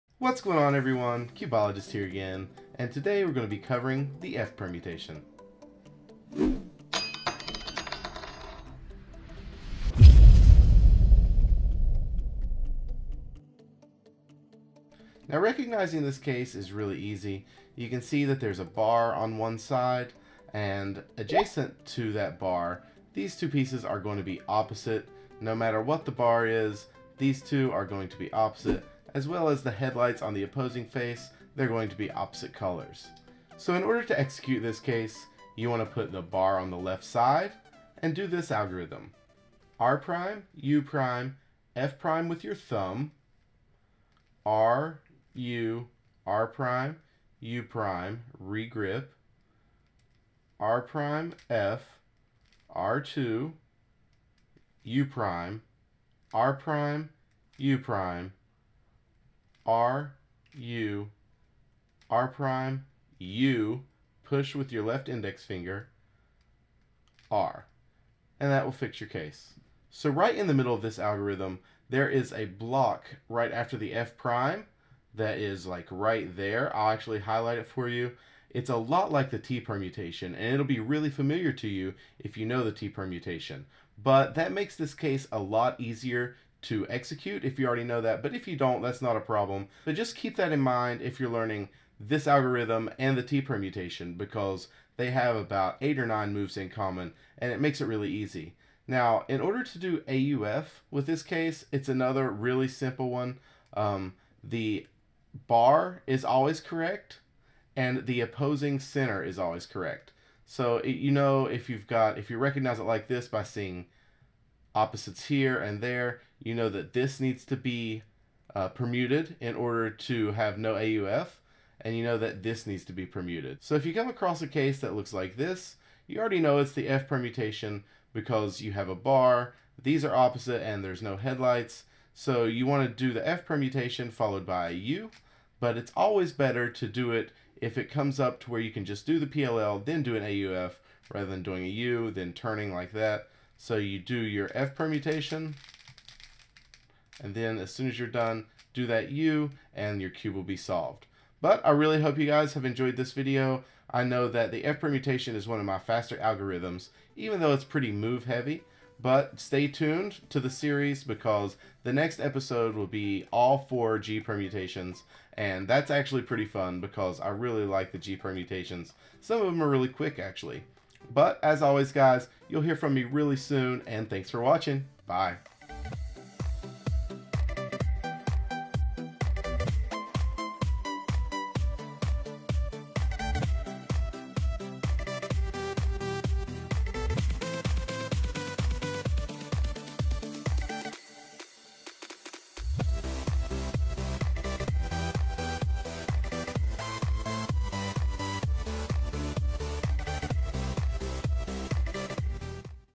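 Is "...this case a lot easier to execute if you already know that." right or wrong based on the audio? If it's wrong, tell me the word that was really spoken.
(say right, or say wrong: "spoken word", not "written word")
right.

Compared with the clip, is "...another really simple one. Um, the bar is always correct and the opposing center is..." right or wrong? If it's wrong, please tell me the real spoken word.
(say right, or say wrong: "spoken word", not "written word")
right.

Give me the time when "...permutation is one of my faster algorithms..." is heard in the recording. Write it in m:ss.
2:34.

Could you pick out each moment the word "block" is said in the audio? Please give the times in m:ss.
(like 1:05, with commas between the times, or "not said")
1:12.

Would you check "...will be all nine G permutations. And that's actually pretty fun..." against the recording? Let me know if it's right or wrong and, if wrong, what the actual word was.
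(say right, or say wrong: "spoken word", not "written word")
wrong: "four", not "nine".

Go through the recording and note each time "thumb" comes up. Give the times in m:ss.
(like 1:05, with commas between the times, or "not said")
0:42.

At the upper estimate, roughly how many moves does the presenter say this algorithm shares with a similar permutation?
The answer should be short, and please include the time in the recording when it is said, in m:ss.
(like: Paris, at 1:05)
9, at 1:36.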